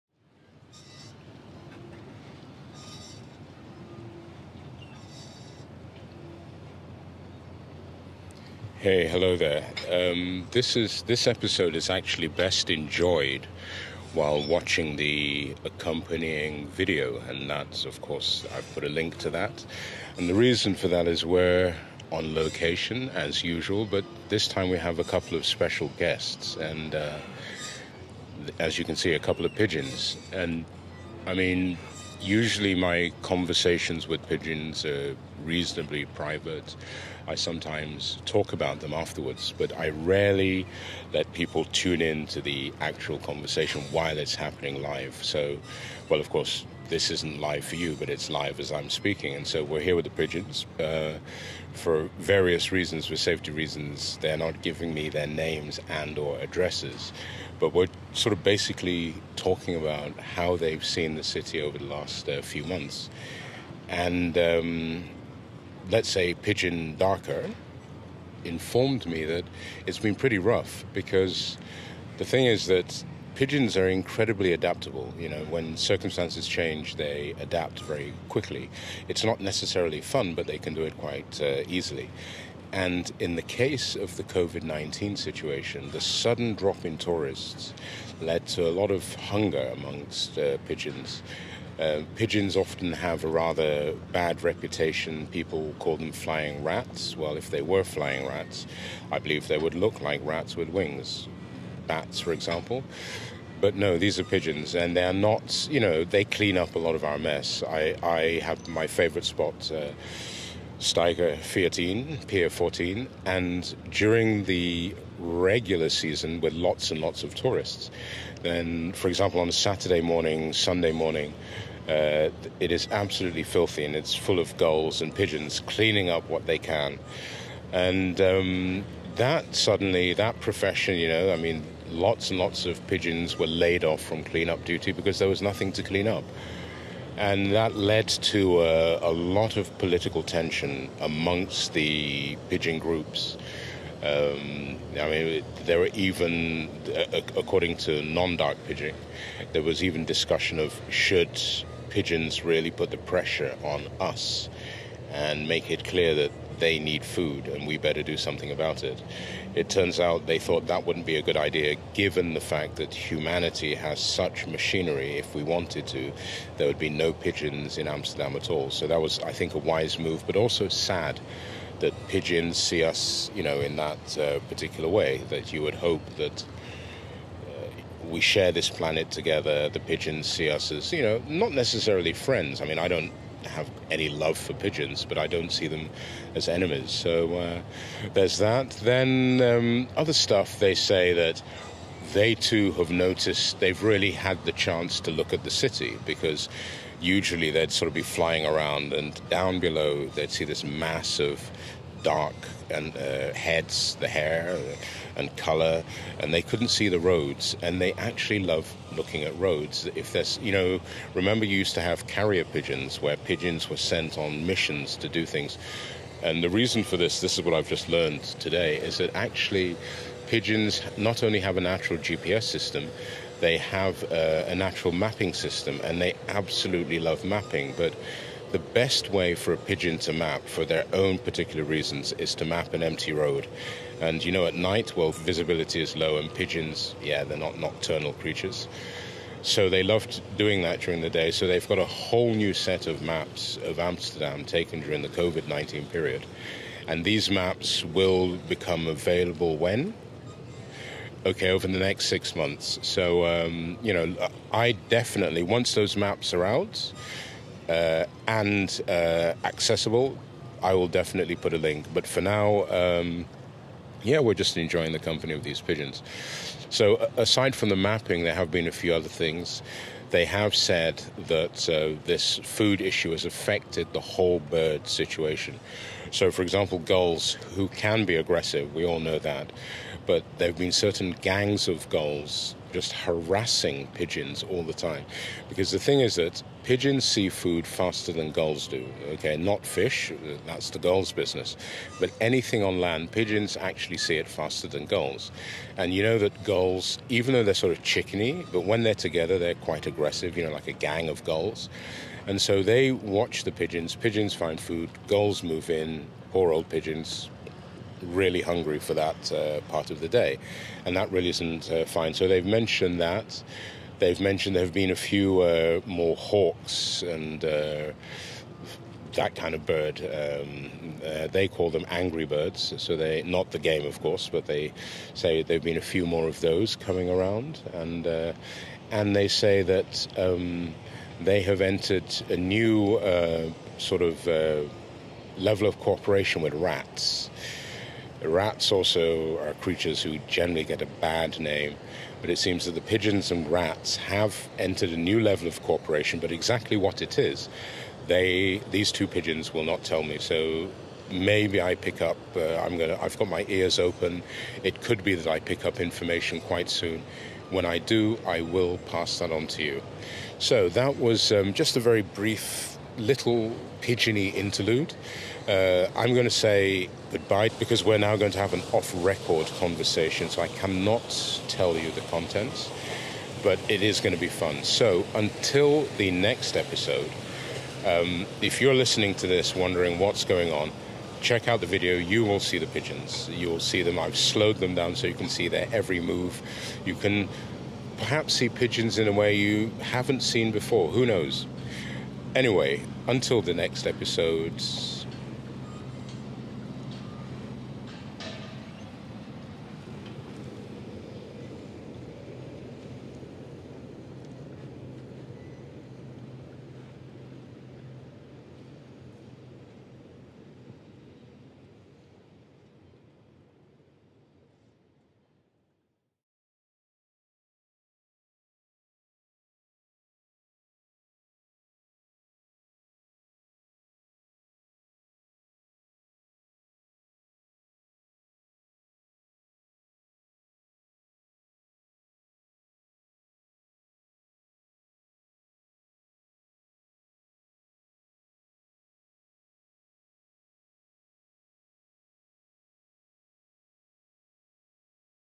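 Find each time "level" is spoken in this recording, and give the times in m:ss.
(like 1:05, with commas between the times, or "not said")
5:35, 5:45.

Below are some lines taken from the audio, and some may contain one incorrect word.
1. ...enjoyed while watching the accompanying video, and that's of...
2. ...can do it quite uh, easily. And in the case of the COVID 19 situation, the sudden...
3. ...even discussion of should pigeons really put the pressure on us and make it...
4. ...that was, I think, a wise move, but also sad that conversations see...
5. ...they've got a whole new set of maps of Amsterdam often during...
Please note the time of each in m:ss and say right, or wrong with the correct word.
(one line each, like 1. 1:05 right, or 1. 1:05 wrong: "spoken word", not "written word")
1. 0:12 right
2. 1:20 right
3. 2:29 right
4. 2:48 wrong: "pigeons", not "conversations"
5. 4:01 wrong: "taken", not "often".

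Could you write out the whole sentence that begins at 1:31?
Uh, pigeons often have a rather bad reputation.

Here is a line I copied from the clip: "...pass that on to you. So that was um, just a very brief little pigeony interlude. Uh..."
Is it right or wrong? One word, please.
right.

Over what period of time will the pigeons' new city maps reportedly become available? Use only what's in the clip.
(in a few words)
next 6 months.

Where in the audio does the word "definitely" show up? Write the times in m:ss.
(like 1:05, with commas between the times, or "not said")
4:14, 4:20.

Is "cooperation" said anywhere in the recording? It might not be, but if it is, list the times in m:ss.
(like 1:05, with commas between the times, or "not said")
5:35, 5:45.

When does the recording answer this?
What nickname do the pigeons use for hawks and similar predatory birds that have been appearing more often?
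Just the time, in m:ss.
5:21.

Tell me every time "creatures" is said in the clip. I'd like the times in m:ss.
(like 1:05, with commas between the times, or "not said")
3:58, 5:39.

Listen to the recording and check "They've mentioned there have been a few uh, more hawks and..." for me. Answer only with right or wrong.
right.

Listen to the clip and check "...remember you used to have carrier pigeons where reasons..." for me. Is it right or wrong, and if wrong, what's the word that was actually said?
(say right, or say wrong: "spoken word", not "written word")
wrong: "pigeons", not "reasons".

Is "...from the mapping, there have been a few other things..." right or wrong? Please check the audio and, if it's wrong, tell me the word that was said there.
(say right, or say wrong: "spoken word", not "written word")
right.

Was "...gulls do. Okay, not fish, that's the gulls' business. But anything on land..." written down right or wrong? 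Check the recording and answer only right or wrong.
right.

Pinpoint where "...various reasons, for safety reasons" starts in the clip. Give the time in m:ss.
0:52.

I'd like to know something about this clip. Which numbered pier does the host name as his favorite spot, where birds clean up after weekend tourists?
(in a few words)
Pier 14.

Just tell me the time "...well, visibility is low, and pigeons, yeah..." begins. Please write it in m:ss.
3:54.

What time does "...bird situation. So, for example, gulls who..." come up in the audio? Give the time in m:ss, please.
4:34.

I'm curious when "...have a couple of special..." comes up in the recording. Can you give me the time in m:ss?
0:24.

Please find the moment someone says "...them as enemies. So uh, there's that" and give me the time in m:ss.
3:05.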